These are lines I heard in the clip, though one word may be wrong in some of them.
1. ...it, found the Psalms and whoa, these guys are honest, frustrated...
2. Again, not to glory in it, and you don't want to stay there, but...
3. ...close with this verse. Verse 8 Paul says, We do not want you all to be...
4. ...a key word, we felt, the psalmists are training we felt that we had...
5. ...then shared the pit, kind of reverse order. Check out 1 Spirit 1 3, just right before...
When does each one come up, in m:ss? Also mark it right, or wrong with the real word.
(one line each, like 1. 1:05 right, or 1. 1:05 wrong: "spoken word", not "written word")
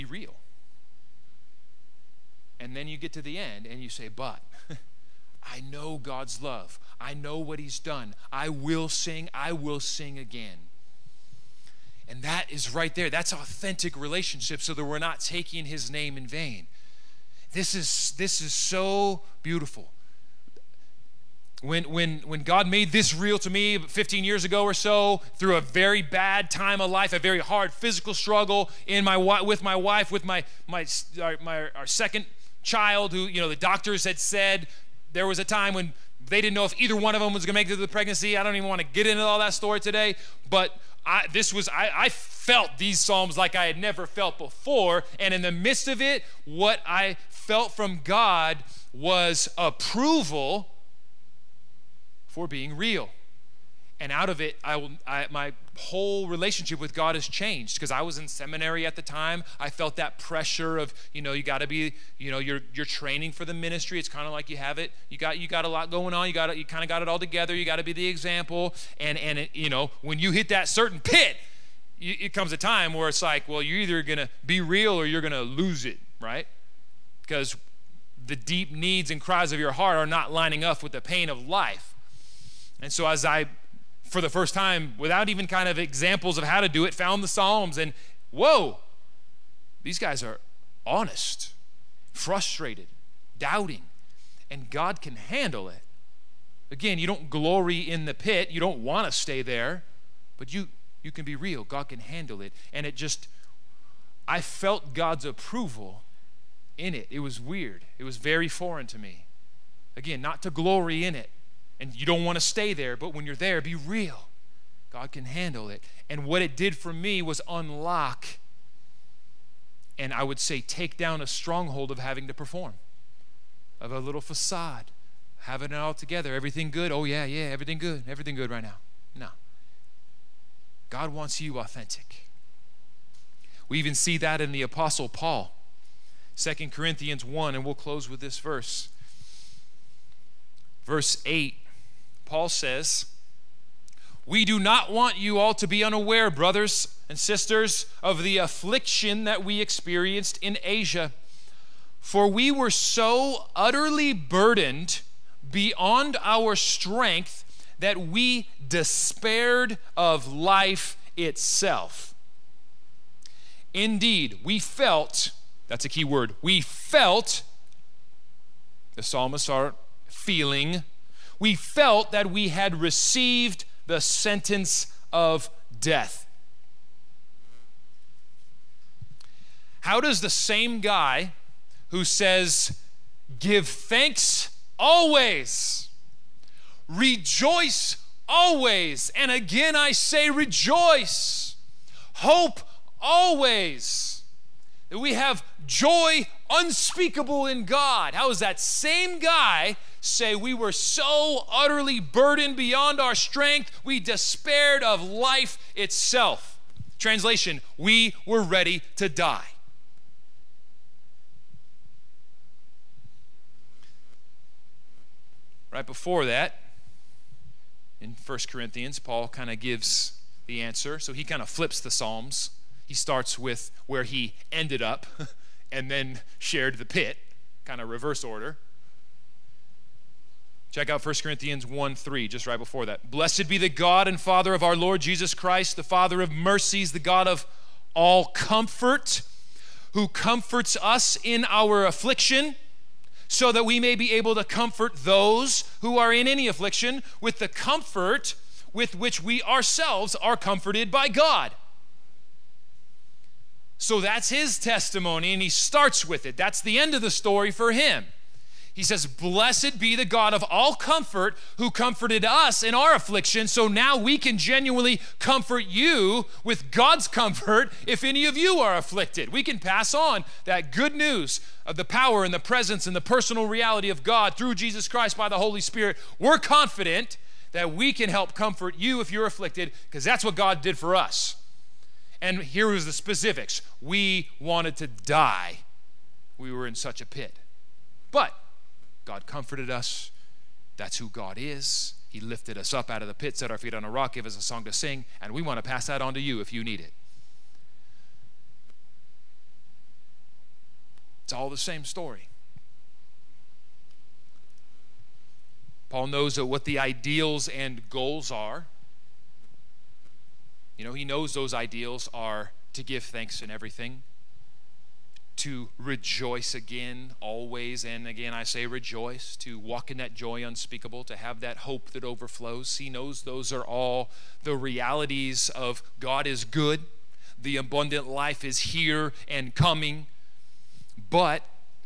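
1. 1:26 right
2. 1:49 right
3. 2:17 right
4. 2:45 wrong: "feeling", not "training"
5. 3:45 wrong: "Corinthians", not "Spirit".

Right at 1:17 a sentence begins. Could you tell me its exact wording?
Because the deep needs and cries of your heart are not lining up with the pain of life.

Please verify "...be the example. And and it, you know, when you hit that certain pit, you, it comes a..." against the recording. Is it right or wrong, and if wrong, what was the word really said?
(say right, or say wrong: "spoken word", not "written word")
right.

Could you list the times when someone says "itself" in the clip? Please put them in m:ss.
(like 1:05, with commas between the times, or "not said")
2:41, 3:25.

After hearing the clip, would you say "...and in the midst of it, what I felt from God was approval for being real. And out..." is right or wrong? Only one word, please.
right.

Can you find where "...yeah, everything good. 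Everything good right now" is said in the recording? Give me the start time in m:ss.
2:07.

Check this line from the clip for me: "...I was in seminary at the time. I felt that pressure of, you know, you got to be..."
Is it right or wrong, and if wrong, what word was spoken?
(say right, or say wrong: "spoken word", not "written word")
right.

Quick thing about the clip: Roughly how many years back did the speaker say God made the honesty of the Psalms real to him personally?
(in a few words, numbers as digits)
15 years.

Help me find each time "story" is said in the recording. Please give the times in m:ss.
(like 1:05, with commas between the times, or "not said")
0:39, 4:17, 5:01.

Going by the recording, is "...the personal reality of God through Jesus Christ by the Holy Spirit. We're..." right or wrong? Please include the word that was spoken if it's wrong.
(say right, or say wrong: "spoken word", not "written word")
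right.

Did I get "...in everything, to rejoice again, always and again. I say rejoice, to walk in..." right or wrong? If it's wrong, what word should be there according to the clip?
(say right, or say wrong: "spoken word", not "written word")
right.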